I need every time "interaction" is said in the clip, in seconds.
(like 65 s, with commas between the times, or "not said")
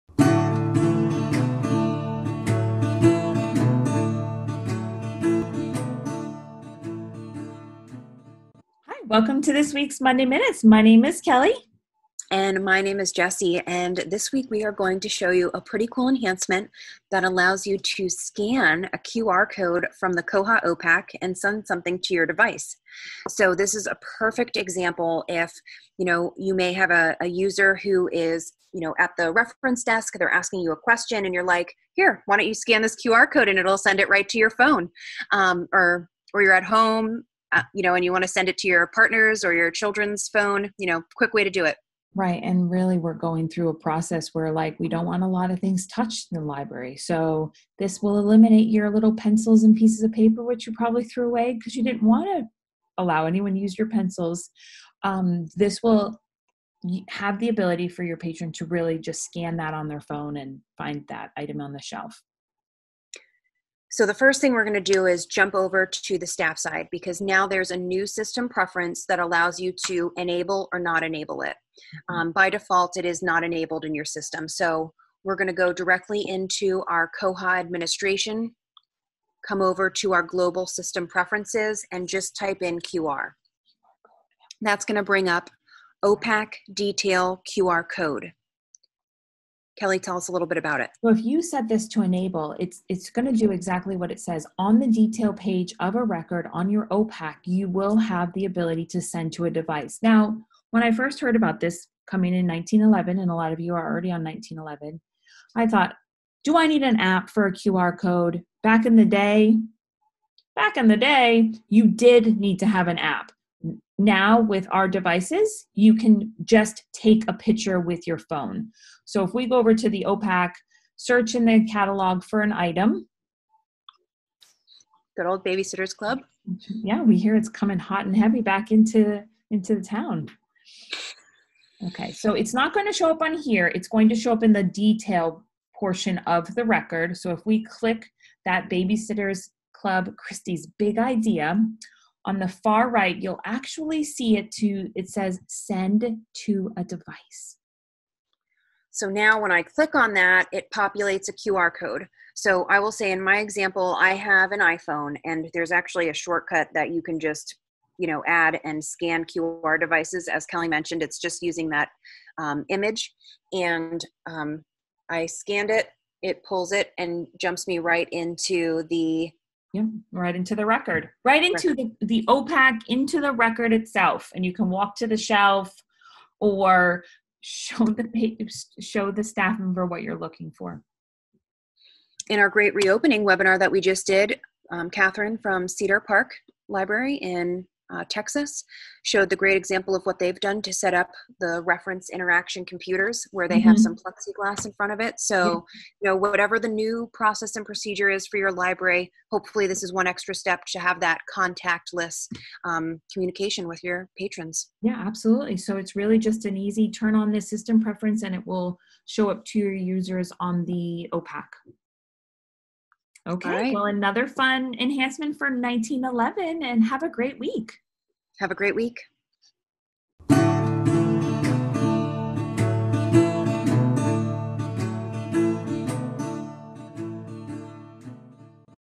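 192 s.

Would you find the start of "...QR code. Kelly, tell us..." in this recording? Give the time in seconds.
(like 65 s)
87 s.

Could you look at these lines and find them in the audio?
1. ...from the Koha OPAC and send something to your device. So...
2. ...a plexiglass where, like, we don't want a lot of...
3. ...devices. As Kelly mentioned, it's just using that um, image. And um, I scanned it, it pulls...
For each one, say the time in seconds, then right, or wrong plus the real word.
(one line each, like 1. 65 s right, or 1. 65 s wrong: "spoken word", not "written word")
1. 19 s right
2. 43 s wrong: "process", not "plexiglass"
3. 159 s right.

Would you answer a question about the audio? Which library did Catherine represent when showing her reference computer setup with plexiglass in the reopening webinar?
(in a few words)
Cedar Park Library.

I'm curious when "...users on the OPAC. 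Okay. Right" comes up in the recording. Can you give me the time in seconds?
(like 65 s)
209 s.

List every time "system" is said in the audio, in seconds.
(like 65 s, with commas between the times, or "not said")
68 s, 74 s, 80 s, 207 s.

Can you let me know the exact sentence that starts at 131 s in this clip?
Okay, so it's not going to show up on here.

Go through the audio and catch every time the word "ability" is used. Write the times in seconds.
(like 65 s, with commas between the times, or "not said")
57 s, 98 s.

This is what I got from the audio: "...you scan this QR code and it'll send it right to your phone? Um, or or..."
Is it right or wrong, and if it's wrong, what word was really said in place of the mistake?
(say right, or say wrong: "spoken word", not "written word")
right.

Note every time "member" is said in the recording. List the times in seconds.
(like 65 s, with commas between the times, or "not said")
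179 s.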